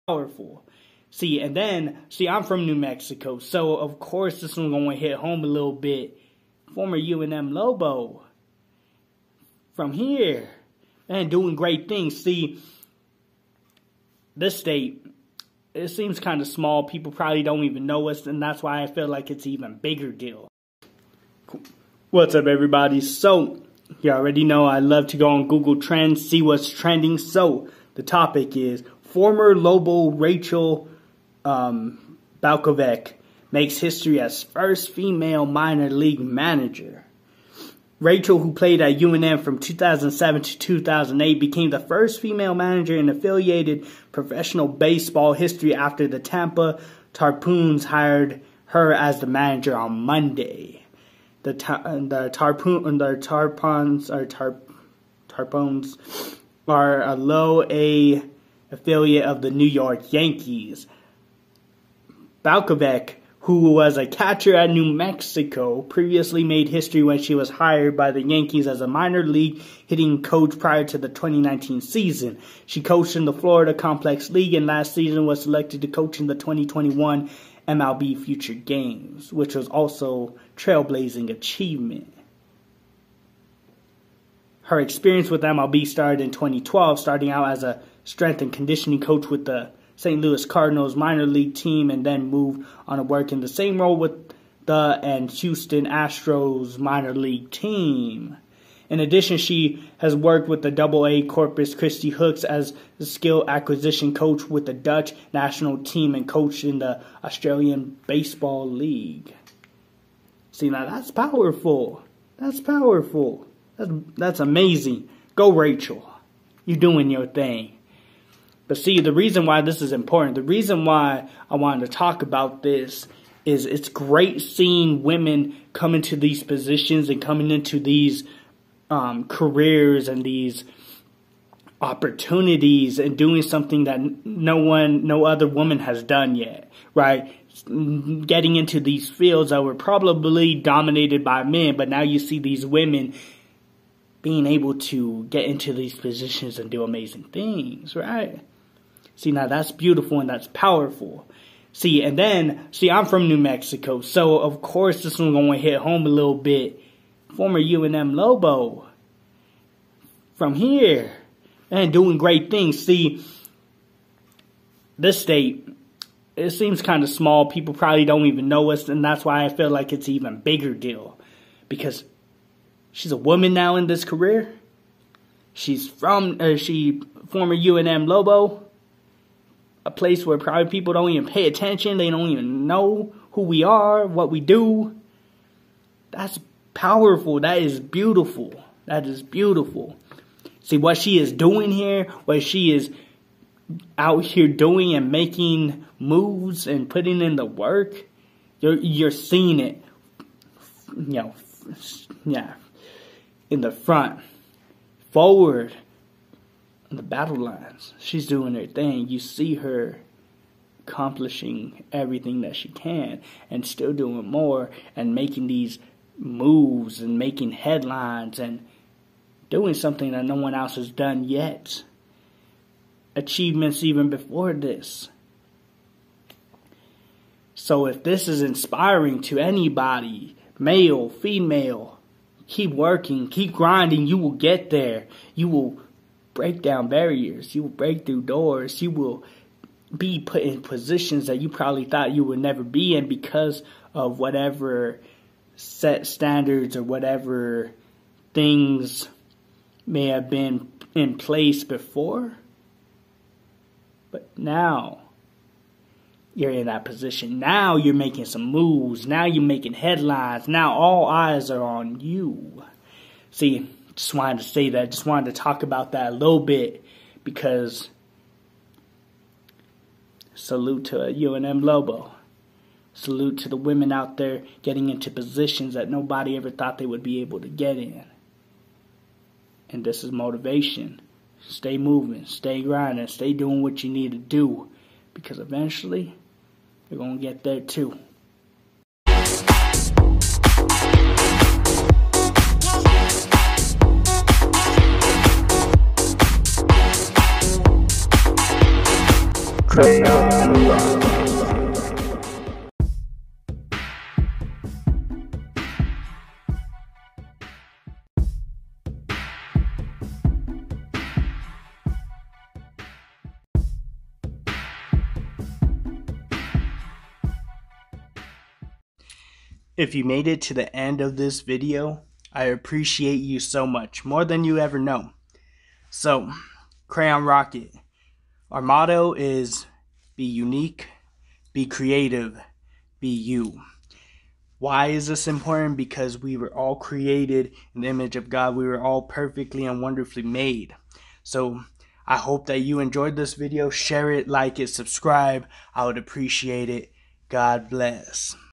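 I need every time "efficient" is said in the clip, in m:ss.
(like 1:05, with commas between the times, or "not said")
not said.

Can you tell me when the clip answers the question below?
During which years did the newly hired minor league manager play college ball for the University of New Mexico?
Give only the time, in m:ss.
0:39.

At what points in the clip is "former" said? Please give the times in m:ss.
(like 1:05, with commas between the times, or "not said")
0:06, 0:29, 2:37, 2:57.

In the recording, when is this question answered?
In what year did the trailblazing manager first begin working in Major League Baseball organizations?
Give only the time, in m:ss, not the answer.
1:26.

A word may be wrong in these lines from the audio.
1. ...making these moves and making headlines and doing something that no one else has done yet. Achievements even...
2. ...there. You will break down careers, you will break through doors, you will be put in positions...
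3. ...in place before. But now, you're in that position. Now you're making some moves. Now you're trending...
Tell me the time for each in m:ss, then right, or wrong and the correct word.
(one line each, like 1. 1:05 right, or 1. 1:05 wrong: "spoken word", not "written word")
1. 3:35 right
2. 3:54 wrong: "barriers", not "careers"
3. 4:10 wrong: "making", not "trending".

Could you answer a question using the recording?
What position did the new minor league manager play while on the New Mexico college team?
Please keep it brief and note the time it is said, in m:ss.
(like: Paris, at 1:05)
Catcher, at 1:04.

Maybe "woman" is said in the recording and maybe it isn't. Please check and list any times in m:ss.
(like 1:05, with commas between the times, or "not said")
2:15, 2:53.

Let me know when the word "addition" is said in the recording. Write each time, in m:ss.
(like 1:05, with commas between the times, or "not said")
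1:39.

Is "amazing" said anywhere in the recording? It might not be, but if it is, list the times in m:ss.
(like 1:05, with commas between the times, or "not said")
1:54, 2:26.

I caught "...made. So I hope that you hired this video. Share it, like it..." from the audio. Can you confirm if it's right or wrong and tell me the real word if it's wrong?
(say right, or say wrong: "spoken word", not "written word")
wrong: "enjoyed", not "hired".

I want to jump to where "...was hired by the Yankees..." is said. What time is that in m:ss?
1:07.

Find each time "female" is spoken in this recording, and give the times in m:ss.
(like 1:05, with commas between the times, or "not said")
0:34, 0:42, 3:51.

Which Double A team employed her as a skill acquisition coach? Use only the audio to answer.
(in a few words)
Corpus Christi Hooks.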